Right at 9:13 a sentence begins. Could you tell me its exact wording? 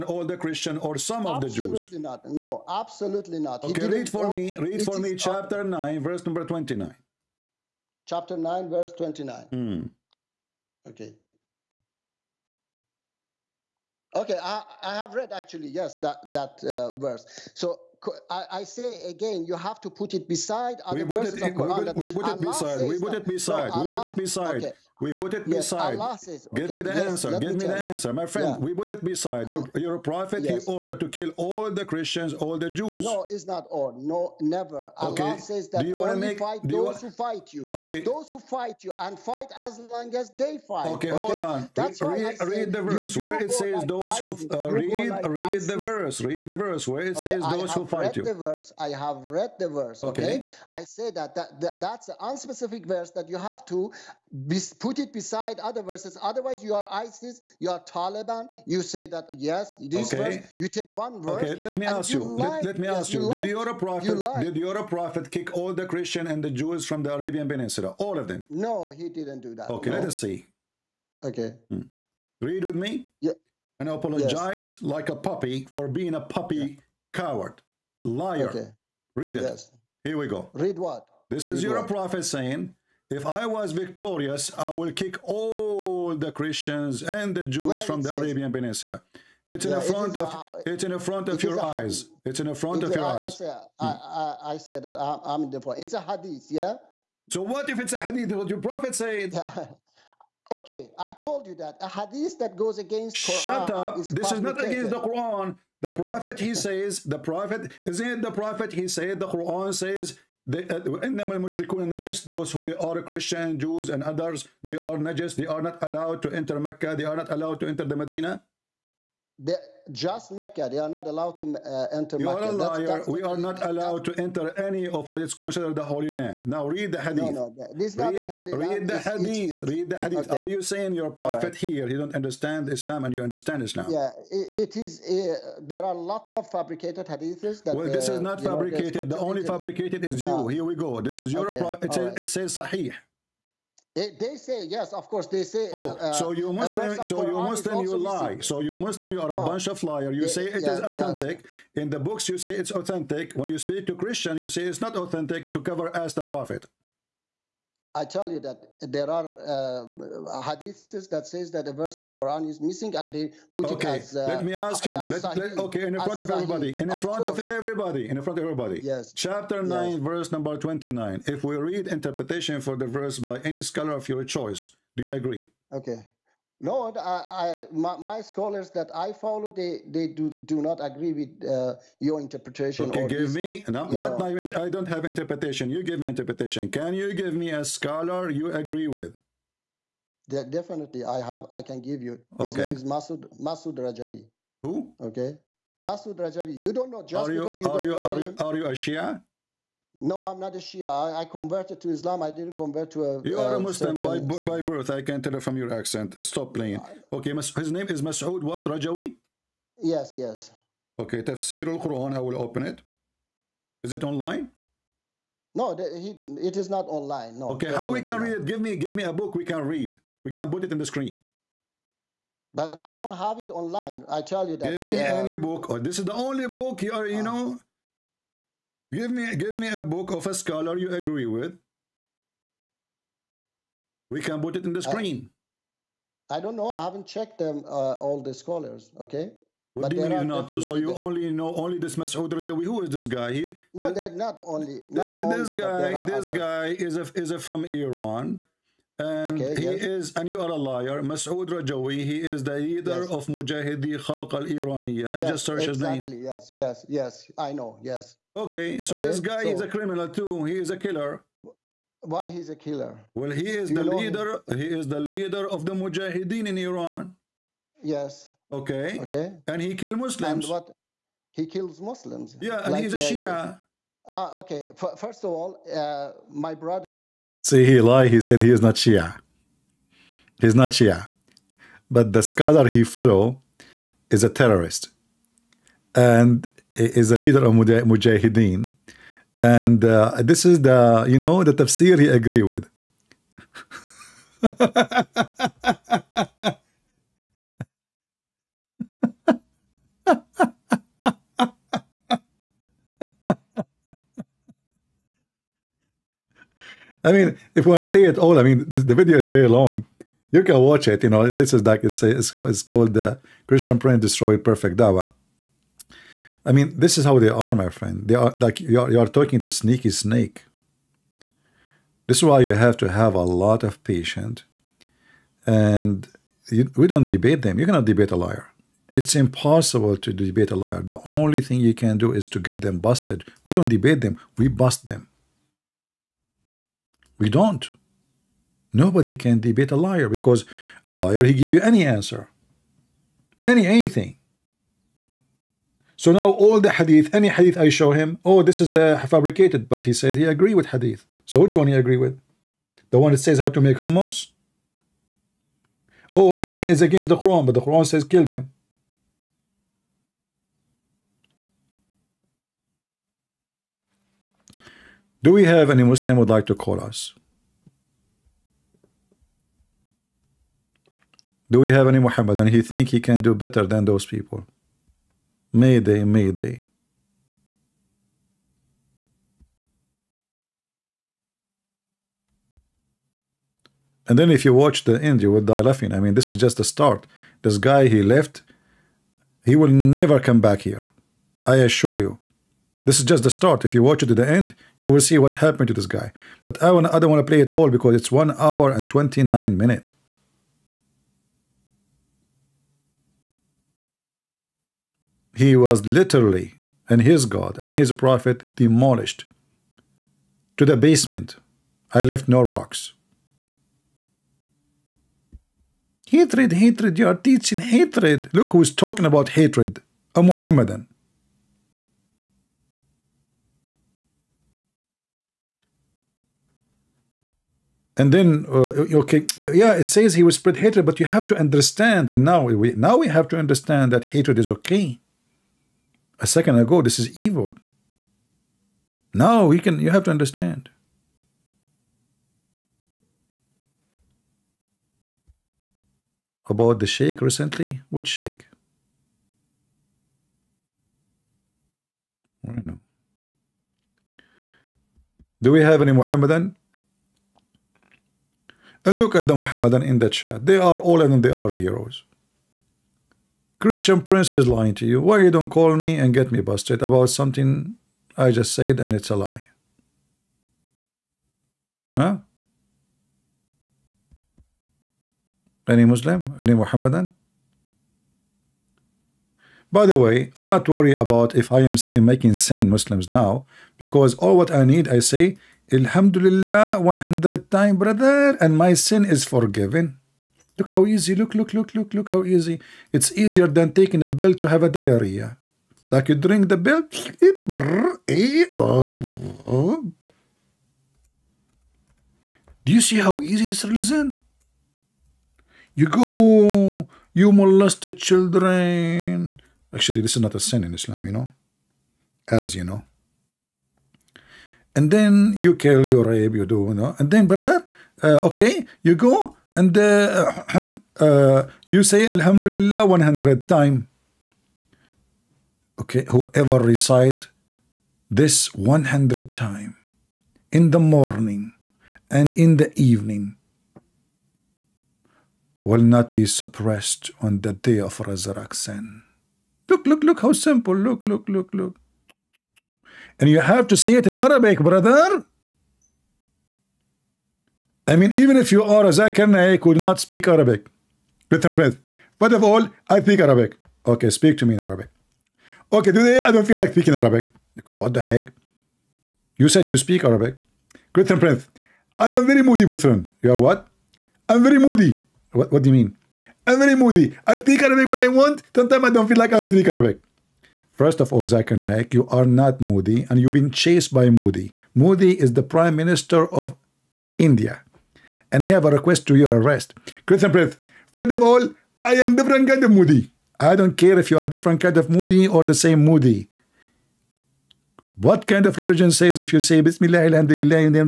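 Okay, speak to me in Arabic.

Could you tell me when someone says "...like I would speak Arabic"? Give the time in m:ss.
9:29.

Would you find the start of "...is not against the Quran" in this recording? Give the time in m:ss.
1:44.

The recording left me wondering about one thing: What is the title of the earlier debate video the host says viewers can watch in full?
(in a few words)
Christian Prince Destroyed Perfect Dawa.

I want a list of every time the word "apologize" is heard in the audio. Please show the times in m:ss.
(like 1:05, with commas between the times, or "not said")
1:13.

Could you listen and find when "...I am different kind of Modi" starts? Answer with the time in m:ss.
9:41.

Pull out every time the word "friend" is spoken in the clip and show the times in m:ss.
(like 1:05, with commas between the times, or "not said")
0:28, 5:17.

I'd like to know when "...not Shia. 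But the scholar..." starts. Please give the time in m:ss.
4:40.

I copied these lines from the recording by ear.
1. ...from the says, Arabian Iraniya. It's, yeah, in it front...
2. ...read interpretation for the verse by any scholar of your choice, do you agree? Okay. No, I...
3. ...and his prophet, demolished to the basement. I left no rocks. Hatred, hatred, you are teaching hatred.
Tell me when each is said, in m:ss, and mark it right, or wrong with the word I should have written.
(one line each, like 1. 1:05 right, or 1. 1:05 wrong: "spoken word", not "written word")
1. 1:27 wrong: "Peninsula", not "Iraniya"
2. 2:51 right
3. 6:47 right.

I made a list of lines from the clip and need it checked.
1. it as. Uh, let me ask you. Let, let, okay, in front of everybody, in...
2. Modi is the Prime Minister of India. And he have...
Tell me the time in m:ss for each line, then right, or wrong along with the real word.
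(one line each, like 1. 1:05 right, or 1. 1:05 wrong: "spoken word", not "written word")
1. 2:43 right
2. 9:34 right.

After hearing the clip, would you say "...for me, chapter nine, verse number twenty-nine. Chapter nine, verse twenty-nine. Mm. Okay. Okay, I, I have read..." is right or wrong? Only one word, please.
right.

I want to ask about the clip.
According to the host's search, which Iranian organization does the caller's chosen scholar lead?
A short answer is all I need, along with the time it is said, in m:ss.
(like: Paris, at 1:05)
Mujahidi Khalq al Iraniya, at 4:13.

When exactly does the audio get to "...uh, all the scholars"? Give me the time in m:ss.
3:57.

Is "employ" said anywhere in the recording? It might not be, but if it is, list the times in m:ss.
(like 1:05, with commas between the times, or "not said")
not said.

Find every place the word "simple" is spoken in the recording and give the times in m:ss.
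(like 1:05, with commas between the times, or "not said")
9:00.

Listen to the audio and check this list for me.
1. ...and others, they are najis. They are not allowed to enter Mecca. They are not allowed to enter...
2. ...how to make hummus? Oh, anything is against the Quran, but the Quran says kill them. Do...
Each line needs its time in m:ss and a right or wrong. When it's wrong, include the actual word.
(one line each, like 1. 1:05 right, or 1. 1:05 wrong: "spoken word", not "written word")
1. 1:53 right
2. 5:53 right.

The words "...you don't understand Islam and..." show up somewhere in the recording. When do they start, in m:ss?
2:11.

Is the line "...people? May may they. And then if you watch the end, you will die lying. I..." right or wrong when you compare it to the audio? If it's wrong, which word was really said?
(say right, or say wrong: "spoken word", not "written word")
wrong: "laughing", not "lying".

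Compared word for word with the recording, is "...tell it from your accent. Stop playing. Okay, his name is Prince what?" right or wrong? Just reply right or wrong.
wrong.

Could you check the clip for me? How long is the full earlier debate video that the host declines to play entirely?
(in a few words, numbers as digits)
1 hour 29 minutes.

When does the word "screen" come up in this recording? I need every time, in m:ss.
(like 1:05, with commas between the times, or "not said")
3:40, 3:54.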